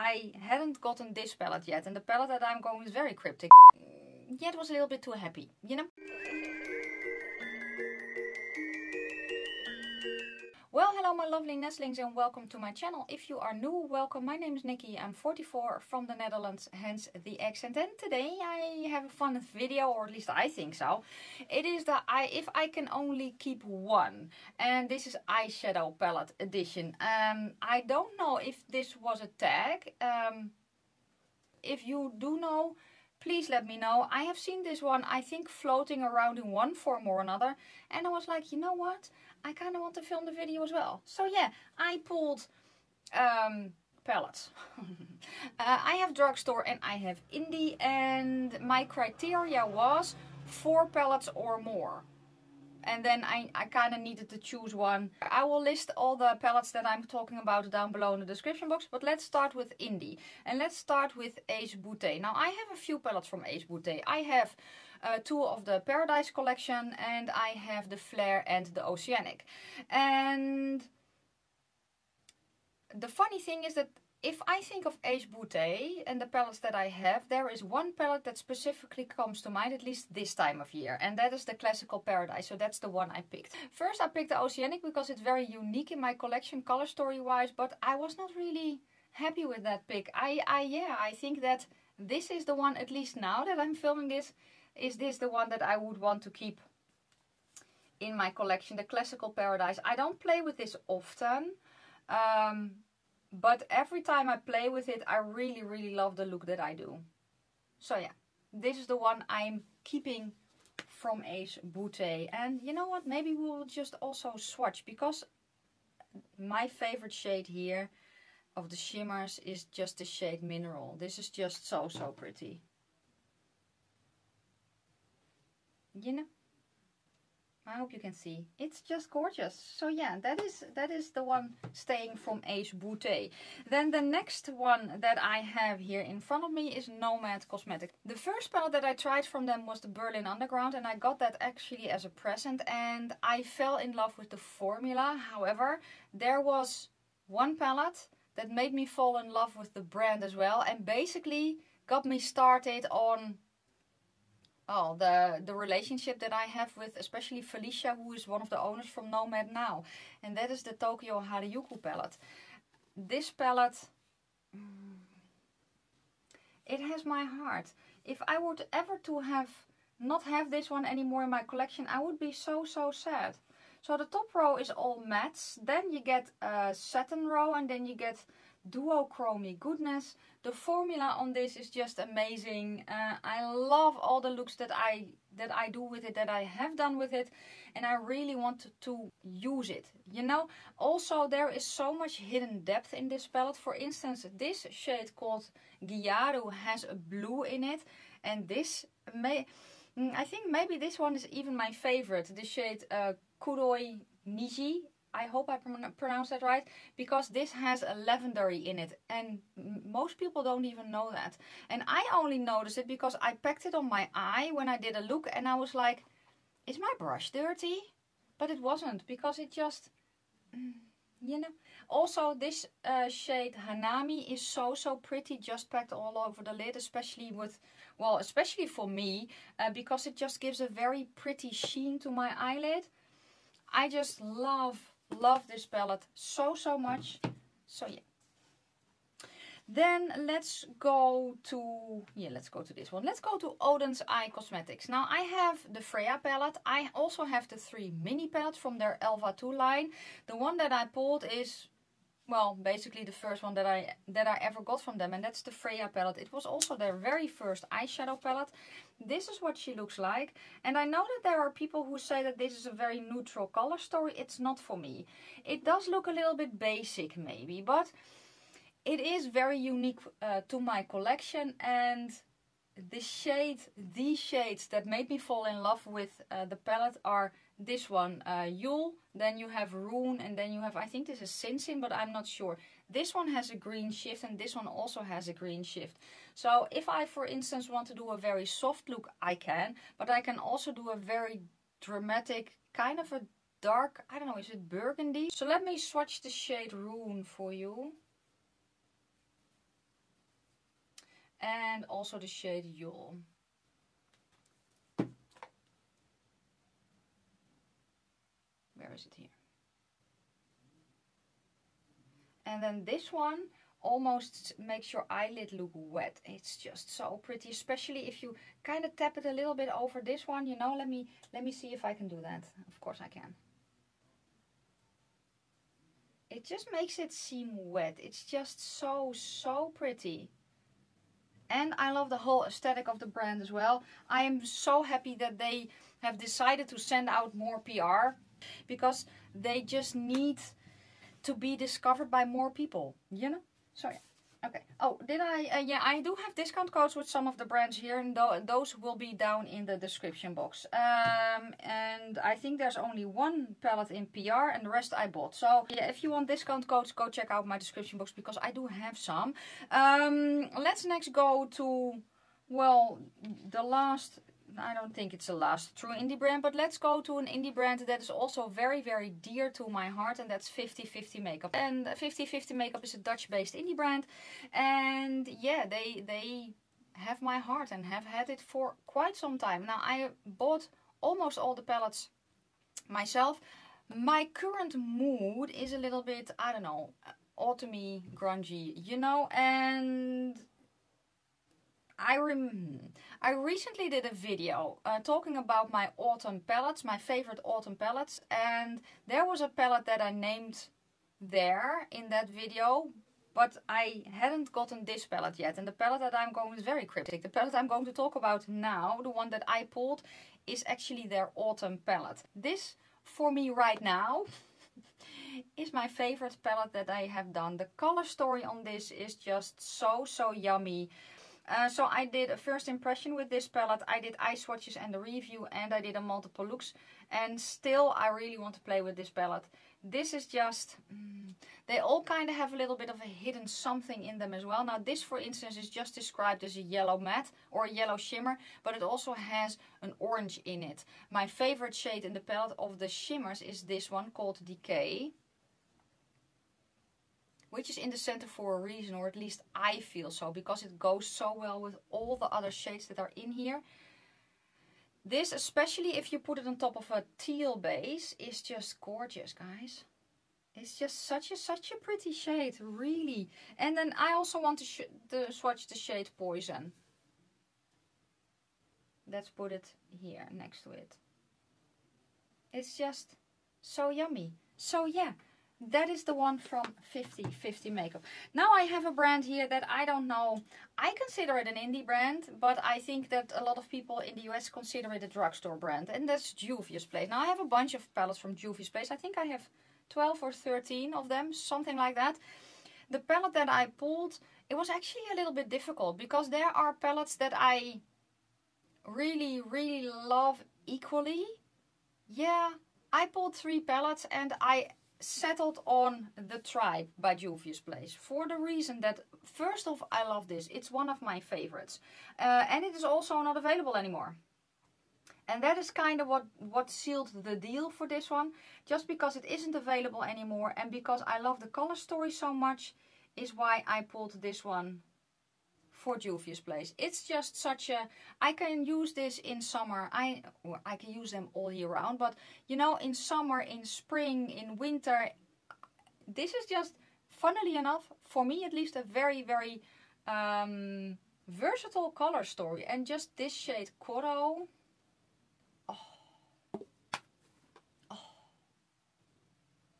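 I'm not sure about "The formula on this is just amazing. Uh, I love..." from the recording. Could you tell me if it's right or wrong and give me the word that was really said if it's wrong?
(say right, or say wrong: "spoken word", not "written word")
right.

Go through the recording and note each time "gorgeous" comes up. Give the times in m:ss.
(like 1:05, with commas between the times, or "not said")
2:09, 7:38.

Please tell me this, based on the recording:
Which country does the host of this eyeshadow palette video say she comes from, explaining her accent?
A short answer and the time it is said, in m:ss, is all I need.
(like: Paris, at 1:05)
the Netherlands, at 0:16.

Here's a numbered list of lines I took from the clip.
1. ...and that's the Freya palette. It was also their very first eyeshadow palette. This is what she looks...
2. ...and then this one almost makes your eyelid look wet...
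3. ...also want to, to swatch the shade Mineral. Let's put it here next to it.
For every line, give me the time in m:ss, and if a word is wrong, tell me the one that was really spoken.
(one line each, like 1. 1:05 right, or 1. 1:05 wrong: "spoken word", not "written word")
1. 4:15 right
2. 5:12 right
3. 7:44 wrong: "Poison", not "Mineral".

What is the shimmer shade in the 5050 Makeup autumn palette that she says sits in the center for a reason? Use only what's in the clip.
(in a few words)
Decay.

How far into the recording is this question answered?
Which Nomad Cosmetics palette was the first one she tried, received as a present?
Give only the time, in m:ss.
2:19.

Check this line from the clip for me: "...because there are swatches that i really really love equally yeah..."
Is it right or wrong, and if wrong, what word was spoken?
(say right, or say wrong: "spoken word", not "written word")
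wrong: "palettes", not "swatches".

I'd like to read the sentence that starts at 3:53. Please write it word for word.
I just love Love this palette so, so much.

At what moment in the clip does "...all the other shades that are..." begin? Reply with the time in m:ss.
7:31.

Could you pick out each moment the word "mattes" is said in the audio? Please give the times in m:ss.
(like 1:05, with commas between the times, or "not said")
2:55, 7:16.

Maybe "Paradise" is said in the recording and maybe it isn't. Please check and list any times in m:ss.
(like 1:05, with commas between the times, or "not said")
1:05, 1:21, 1:39.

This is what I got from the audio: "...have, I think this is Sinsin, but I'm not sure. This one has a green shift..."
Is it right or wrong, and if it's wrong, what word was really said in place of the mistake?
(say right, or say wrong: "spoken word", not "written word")
right.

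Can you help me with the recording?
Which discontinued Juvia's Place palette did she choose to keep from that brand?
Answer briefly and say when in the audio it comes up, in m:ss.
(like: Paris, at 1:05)
The Tribe, at 8:26.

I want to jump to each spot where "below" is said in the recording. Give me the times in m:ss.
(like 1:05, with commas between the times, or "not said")
0:57.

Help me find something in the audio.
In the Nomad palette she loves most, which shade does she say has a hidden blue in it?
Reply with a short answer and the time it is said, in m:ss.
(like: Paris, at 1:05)
Gyaru, at 3:15.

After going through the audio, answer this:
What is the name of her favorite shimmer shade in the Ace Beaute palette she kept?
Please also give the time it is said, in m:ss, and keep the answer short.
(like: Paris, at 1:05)
Mineral, at 2:00.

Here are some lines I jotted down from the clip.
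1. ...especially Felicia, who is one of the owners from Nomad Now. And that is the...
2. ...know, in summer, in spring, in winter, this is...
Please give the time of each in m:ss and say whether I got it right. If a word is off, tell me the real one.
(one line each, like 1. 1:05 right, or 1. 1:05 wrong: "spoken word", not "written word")
1. 2:36 right
2. 8:52 right.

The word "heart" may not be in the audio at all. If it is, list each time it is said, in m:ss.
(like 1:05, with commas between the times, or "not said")
2:47, 6:09, 6:17.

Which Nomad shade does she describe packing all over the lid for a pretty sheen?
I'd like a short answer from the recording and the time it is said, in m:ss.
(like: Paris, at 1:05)
Hanami, at 3:43.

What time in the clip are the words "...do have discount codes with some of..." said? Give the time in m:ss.
5:46.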